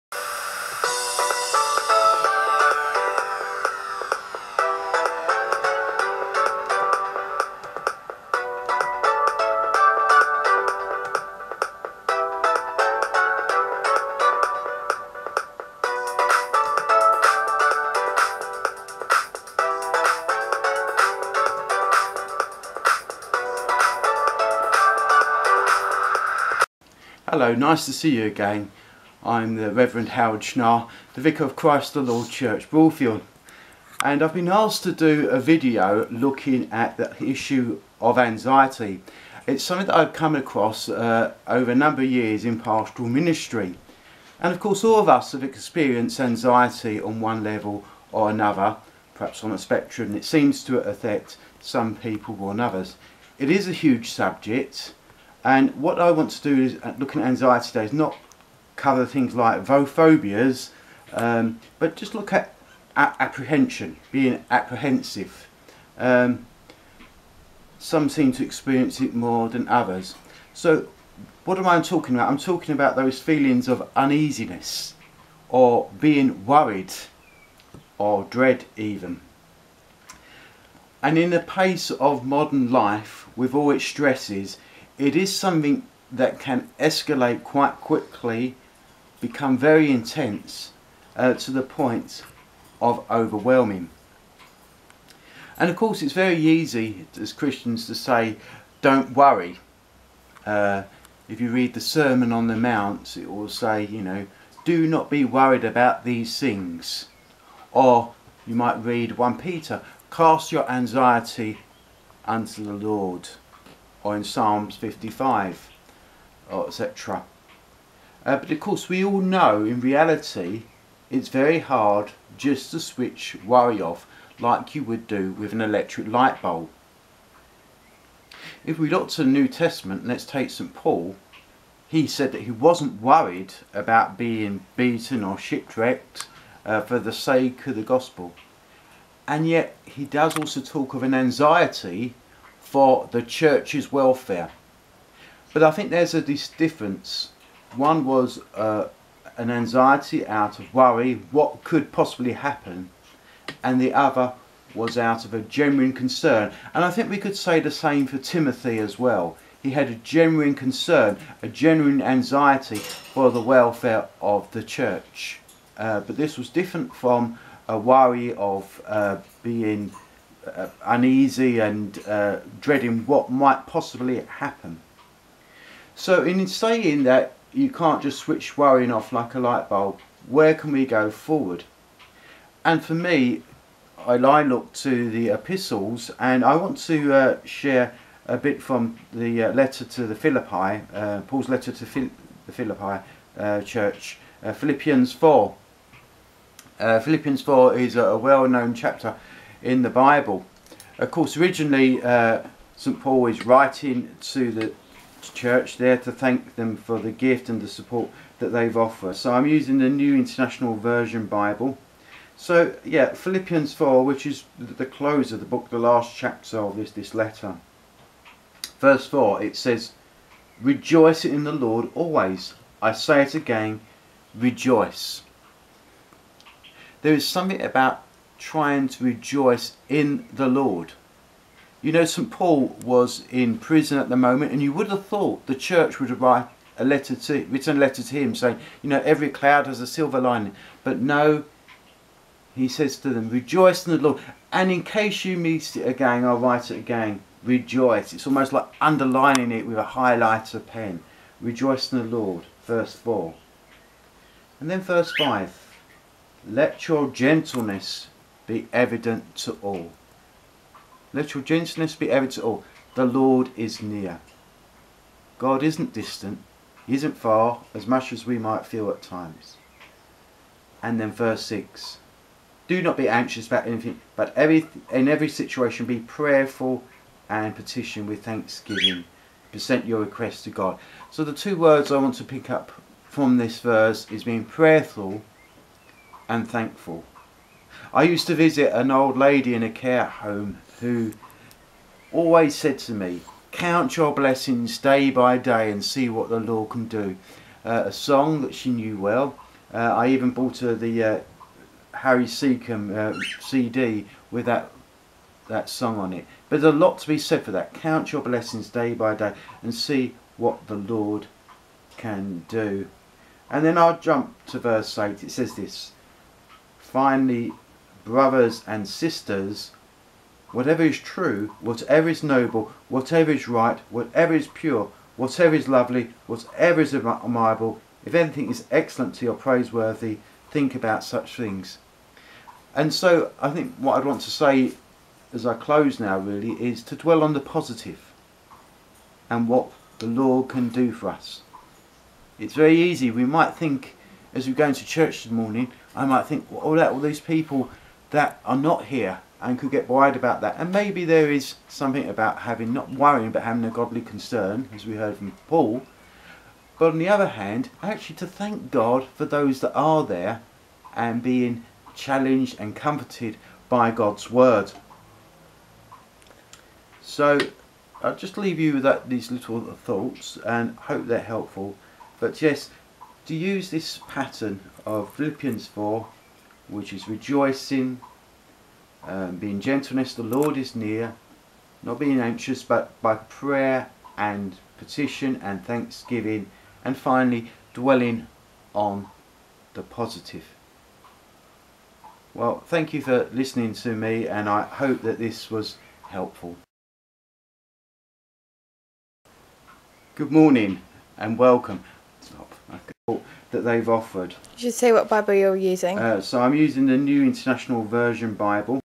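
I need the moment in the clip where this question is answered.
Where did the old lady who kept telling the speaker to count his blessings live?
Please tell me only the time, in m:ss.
4:49.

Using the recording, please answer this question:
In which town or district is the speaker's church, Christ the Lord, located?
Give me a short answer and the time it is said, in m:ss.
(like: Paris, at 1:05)
Broadfield, at 0:32.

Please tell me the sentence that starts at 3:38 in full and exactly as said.
Verse 4, it says, Rejoice in the Lord always.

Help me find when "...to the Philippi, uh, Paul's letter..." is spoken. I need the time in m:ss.
3:09.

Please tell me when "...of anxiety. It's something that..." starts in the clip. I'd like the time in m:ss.
0:38.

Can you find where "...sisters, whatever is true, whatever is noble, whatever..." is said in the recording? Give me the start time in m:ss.
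5:18.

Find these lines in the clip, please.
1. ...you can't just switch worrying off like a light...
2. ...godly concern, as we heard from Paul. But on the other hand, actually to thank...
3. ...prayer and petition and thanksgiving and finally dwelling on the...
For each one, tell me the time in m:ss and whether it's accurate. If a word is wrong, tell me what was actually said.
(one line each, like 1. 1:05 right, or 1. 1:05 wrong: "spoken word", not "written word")
1. 2:57 right
2. 5:53 right
3. 6:23 right.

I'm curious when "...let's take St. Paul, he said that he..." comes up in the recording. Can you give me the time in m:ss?
2:10.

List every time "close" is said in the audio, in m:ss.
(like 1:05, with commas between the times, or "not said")
3:34, 5:35.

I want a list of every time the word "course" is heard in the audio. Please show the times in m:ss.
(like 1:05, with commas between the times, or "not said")
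0:44, 1:35, 1:58, 3:21.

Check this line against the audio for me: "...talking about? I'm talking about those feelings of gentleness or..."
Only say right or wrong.
wrong.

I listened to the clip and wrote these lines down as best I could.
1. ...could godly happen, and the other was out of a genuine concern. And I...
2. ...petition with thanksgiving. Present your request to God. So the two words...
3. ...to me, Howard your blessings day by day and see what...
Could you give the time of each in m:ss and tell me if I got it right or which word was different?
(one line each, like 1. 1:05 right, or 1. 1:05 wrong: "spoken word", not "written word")
1. 2:31 wrong: "possibly", not "godly"
2. 4:37 right
3. 4:52 wrong: "Count", not "Howard".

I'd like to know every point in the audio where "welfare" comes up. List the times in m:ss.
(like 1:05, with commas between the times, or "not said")
2:23, 2:43.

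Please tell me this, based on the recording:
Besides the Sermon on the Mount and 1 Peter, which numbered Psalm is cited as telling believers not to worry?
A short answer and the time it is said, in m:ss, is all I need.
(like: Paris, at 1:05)
Psalm 55, at 1:54.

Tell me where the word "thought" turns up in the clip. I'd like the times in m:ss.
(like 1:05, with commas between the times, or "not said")
3:55, 6:09.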